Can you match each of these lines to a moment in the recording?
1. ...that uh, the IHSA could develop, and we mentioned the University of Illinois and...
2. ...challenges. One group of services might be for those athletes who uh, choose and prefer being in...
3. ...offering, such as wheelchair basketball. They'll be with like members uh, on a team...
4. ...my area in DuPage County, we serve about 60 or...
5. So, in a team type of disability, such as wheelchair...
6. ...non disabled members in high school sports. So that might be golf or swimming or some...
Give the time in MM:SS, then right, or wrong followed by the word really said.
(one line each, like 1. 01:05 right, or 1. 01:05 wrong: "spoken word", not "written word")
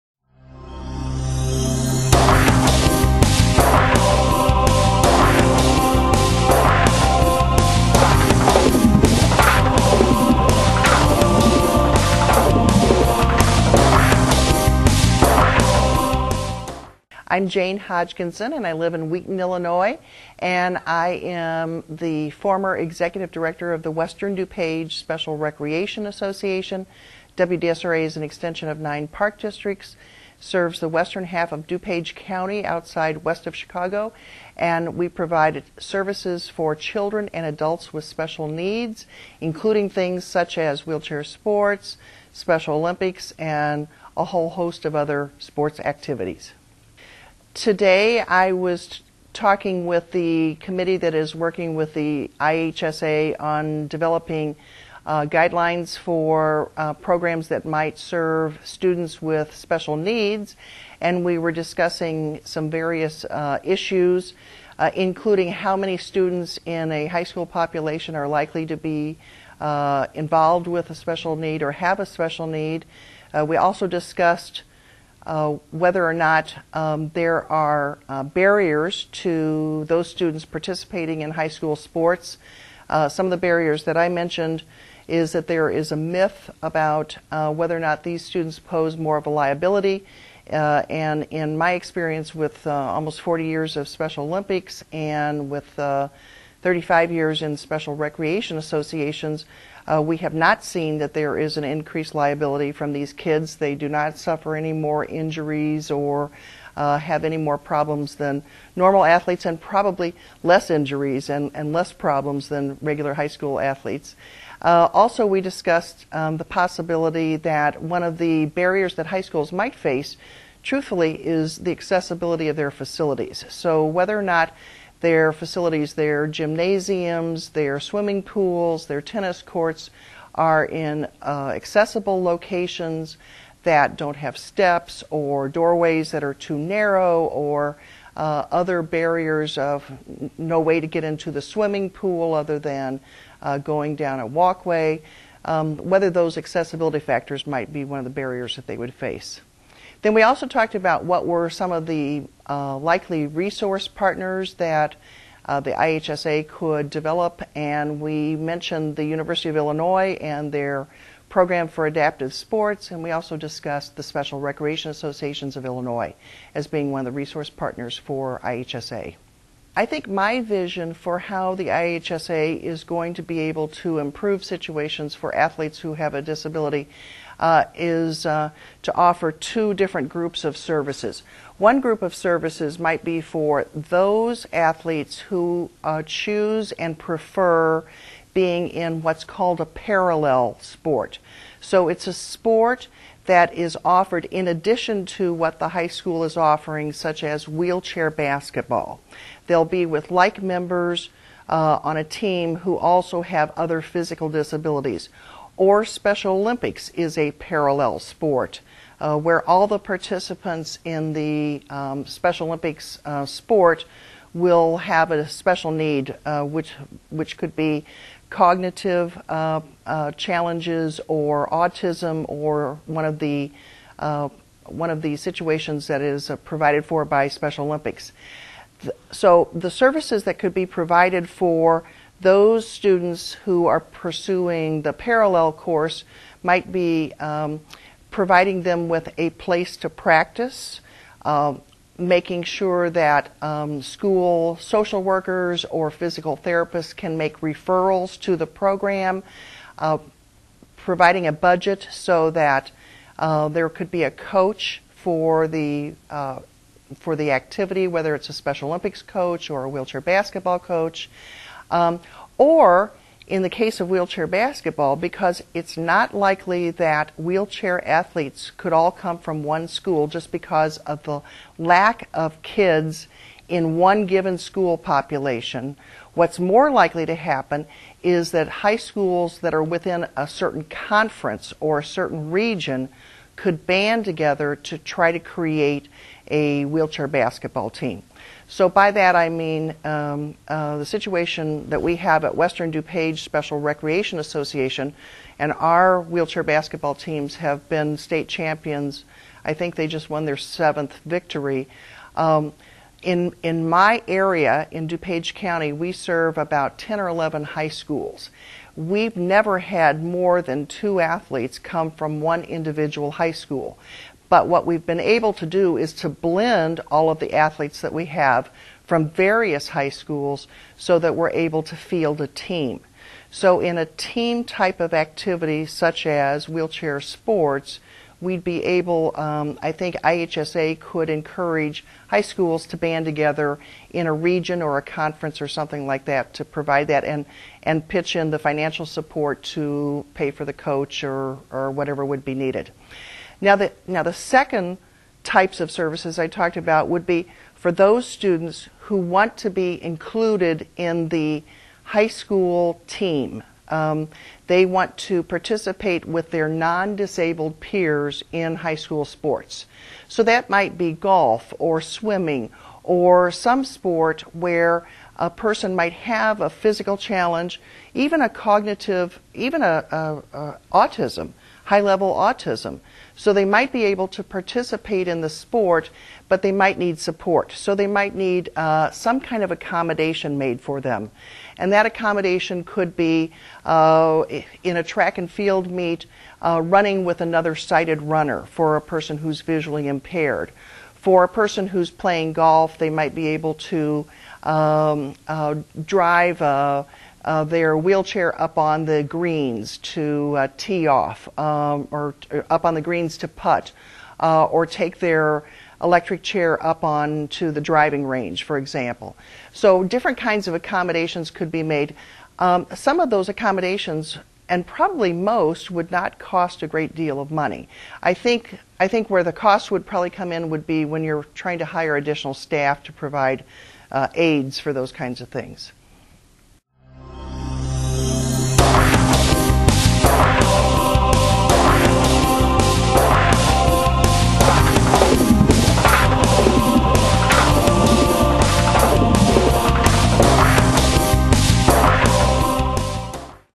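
1. 02:34 right
2. 03:00 wrong: "services", not "challenges"
3. 03:16 right
4. 05:03 wrong: "10", not "60"
5. 05:23 wrong: "activity", not "disability"
6. 05:56 wrong: "peers", not "members".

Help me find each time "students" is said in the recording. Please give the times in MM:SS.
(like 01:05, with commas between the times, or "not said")
00:58, 01:05, 01:20, 01:28, 03:52, 05:48.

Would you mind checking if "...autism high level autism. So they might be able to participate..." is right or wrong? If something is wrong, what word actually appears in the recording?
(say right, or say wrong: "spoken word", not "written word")
right.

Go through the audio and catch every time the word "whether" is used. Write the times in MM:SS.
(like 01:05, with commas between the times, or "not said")
01:15, 01:27, 02:03, 02:25, 04:17.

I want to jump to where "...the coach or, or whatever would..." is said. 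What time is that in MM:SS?
05:40.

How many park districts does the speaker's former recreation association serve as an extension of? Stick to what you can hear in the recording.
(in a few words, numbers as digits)
9.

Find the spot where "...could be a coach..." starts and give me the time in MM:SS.
04:13.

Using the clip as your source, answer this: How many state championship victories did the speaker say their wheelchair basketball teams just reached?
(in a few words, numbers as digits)
7.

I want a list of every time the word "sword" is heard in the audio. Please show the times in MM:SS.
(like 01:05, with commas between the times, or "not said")
not said.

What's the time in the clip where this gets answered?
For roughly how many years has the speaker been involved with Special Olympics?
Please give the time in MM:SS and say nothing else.
01:32.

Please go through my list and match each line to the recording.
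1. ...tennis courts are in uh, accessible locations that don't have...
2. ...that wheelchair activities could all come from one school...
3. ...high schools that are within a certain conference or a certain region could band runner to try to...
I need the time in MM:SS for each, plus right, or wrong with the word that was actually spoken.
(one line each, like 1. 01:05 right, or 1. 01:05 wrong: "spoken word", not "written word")
1. 02:09 right
2. 04:26 wrong: "athletes", not "activities"
3. 04:38 wrong: "together", not "runner".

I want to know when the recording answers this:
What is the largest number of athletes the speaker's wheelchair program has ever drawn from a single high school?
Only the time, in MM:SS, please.
05:10.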